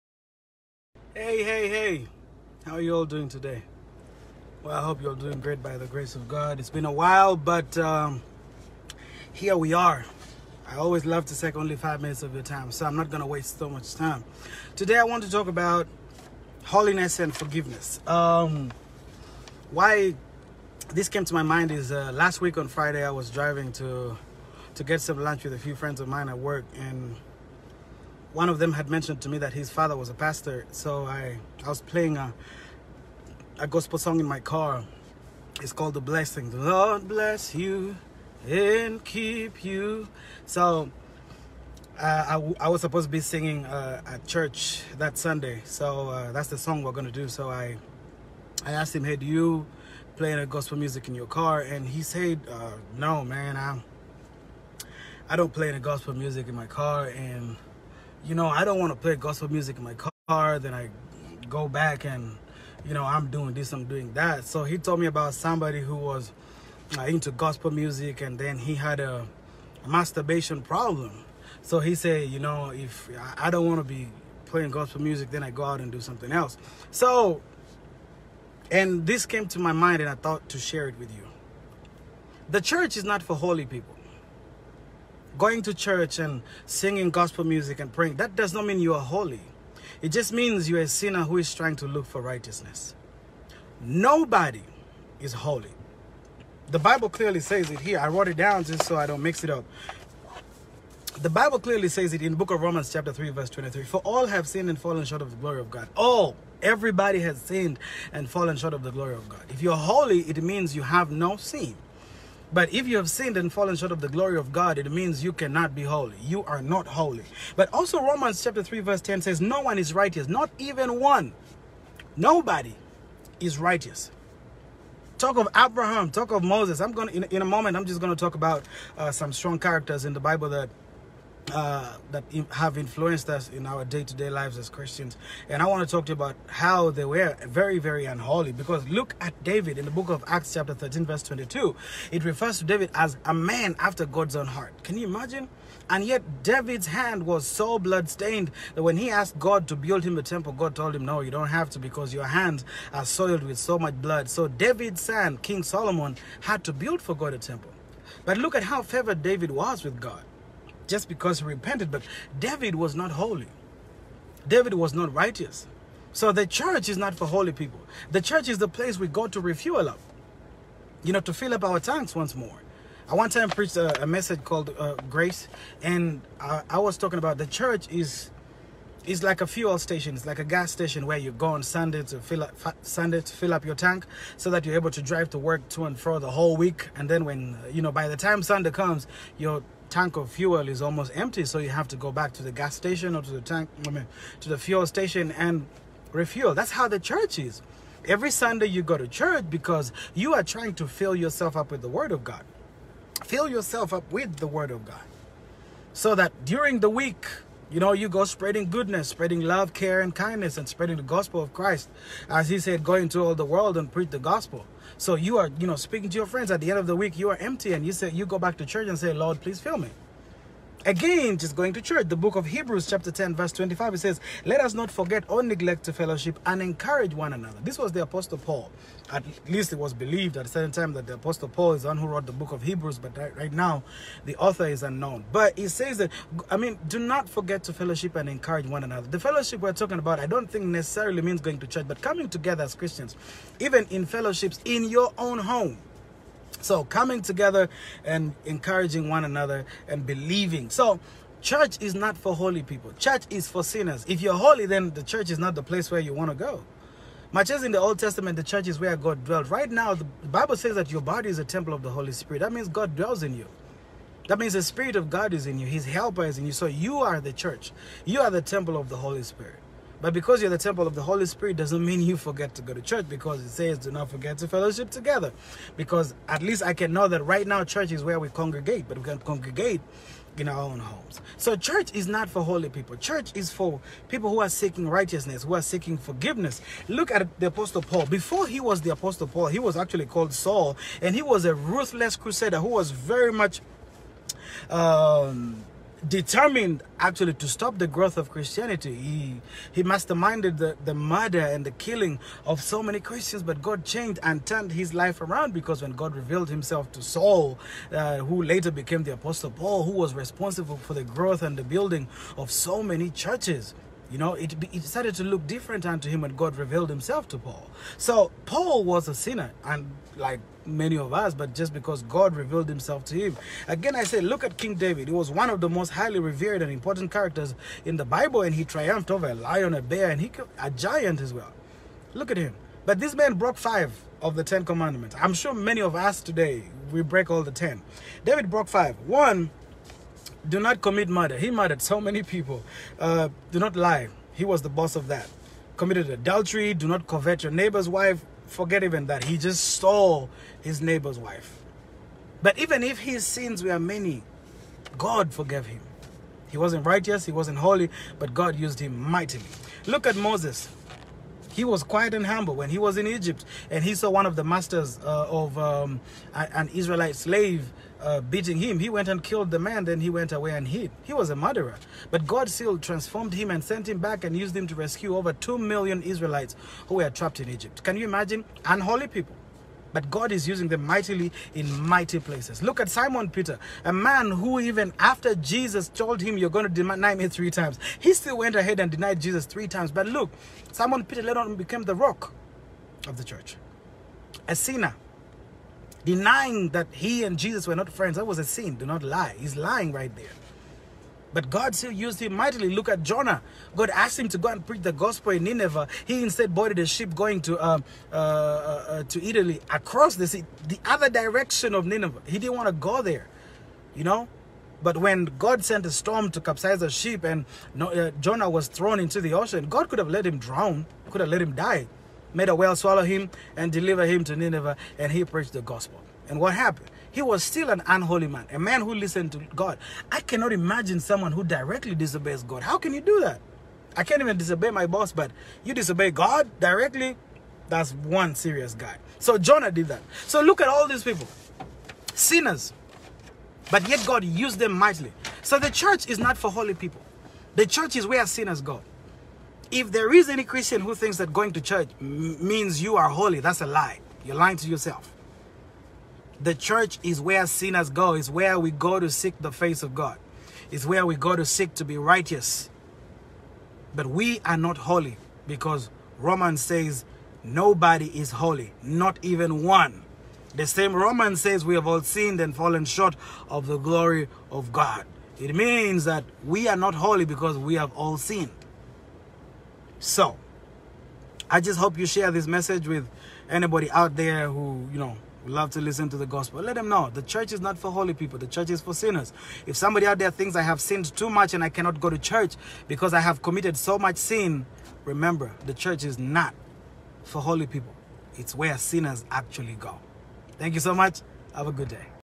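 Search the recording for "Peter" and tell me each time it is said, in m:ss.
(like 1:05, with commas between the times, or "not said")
6:23, 6:31.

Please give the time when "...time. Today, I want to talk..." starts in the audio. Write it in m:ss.
0:13.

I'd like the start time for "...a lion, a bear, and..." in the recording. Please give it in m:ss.
5:29.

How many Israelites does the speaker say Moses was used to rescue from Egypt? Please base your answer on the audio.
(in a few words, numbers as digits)
Over 2 million.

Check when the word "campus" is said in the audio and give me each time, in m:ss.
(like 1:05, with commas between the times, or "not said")
not said.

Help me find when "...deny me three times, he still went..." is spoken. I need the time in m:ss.
6:26.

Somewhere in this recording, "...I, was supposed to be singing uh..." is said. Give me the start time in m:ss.
0:42.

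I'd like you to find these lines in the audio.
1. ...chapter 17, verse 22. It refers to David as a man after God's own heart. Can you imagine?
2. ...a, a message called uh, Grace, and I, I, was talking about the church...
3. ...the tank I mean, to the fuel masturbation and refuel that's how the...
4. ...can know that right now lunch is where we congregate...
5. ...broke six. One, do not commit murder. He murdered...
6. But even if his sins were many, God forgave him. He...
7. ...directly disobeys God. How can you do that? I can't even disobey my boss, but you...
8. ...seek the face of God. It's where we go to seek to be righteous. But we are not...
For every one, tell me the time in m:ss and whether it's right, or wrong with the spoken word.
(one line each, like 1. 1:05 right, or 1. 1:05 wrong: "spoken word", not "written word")
1. 2:20 wrong: "13", not "17"
2. 2:53 right
3. 3:13 wrong: "station", not "masturbation"
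4. 4:36 wrong: "church", not "lunch"
5. 5:38 wrong: "five", not "six"
6. 5:52 right
7. 7:11 right
8. 7:39 right.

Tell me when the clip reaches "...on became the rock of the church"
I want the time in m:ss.
6:31.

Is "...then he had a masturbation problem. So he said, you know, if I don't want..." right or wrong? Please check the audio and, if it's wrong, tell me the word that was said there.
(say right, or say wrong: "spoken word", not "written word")
right.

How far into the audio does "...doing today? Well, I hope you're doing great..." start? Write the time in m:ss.
0:03.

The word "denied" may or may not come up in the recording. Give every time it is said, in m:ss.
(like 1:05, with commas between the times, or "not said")
6:28.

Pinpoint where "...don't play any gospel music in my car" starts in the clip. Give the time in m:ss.
0:55.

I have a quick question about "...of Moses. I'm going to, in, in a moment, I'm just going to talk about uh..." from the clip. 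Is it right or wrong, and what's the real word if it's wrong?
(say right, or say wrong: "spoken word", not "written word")
right.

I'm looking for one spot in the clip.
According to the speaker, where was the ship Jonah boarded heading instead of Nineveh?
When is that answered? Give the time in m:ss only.
6:49.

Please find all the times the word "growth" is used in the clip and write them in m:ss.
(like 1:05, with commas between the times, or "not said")
4:57, 5:11.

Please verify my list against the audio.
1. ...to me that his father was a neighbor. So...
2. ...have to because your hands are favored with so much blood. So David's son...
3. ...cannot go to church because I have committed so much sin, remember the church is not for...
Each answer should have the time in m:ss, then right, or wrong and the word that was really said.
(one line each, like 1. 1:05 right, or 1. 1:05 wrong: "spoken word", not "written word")
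1. 0:29 wrong: "pastor", not "neighbor"
2. 2:31 wrong: "soiled", not "favored"
3. 8:11 right.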